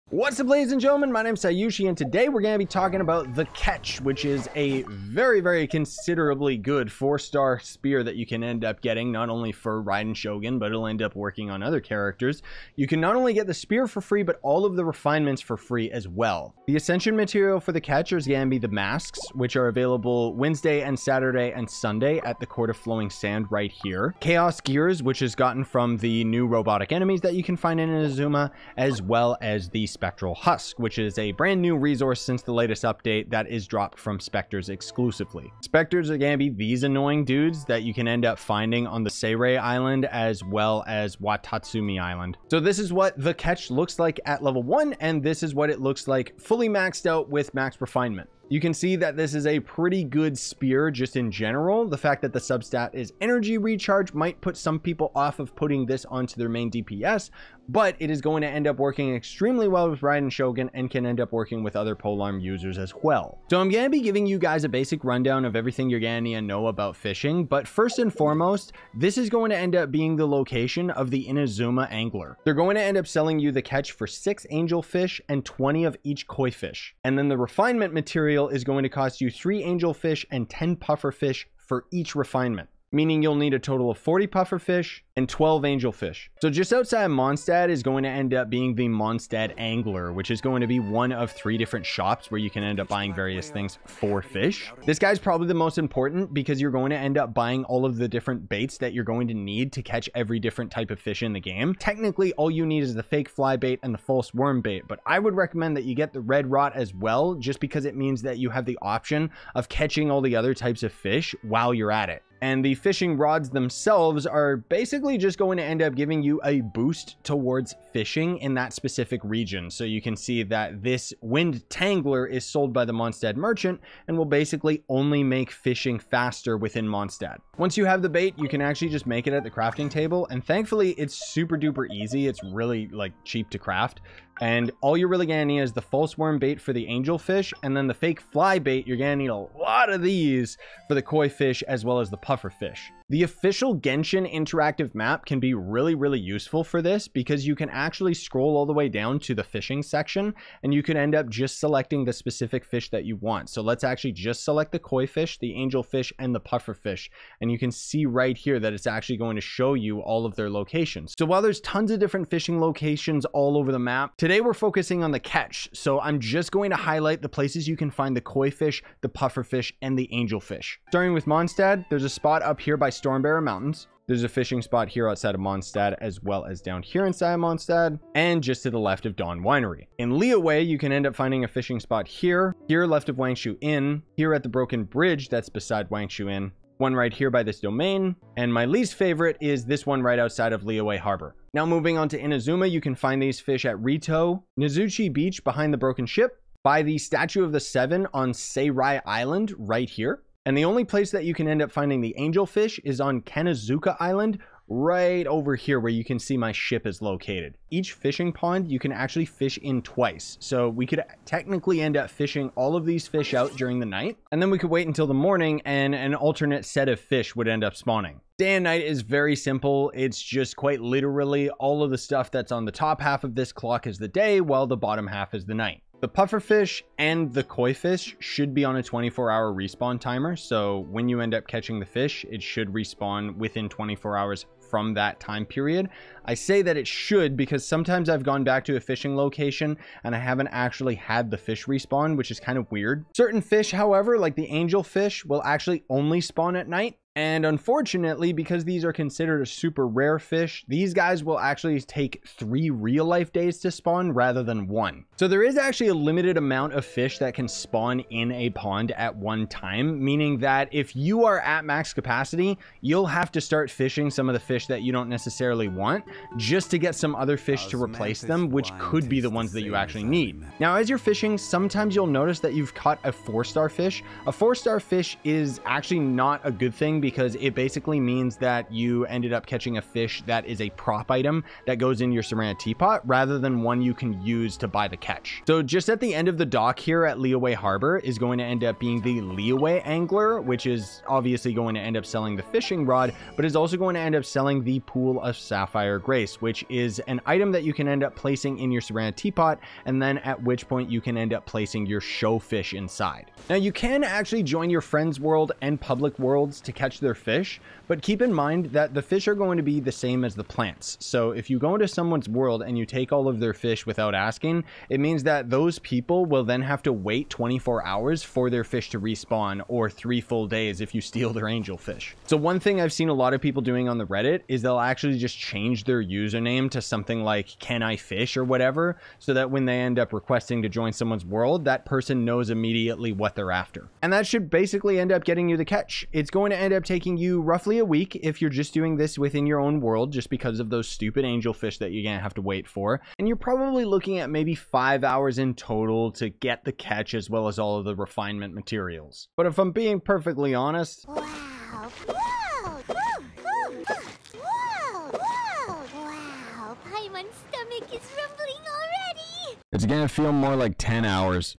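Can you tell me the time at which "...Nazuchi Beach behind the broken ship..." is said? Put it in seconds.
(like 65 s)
194 s.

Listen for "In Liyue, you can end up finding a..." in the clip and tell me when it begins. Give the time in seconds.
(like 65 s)
179 s.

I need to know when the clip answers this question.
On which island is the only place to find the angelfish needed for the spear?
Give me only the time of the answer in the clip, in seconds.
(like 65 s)
203 s.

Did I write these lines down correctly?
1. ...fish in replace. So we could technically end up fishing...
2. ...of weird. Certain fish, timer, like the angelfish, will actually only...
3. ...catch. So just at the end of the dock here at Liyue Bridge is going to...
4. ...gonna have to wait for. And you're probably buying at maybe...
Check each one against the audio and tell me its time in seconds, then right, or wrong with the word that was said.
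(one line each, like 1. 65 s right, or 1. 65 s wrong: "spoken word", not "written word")
1. 209 s wrong: "twice", not "replace"
2. 242 s wrong: "however", not "timer"
3. 284 s wrong: "Harbor", not "Bridge"
4. 342 s wrong: "looking", not "buying".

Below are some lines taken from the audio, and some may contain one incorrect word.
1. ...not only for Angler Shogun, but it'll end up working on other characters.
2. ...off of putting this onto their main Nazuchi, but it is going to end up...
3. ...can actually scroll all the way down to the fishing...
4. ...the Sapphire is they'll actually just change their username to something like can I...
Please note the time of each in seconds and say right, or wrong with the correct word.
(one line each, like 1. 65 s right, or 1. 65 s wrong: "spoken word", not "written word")
1. 9 s wrong: "Raiden", not "Angler"
2. 55 s wrong: "DPS", not "Nazuchi"
3. 147 s right
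4. 323 s wrong: "Reddit", not "Sapphire".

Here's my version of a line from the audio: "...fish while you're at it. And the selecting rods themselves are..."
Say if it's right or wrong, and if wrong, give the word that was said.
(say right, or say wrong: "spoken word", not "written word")
wrong: "fishing", not "selecting".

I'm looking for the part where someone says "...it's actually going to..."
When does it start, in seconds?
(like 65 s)
158 s.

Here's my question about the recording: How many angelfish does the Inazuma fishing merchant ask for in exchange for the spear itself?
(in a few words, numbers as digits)
6.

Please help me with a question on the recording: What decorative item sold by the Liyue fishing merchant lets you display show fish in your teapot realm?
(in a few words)
Pool of Sapphire Grace.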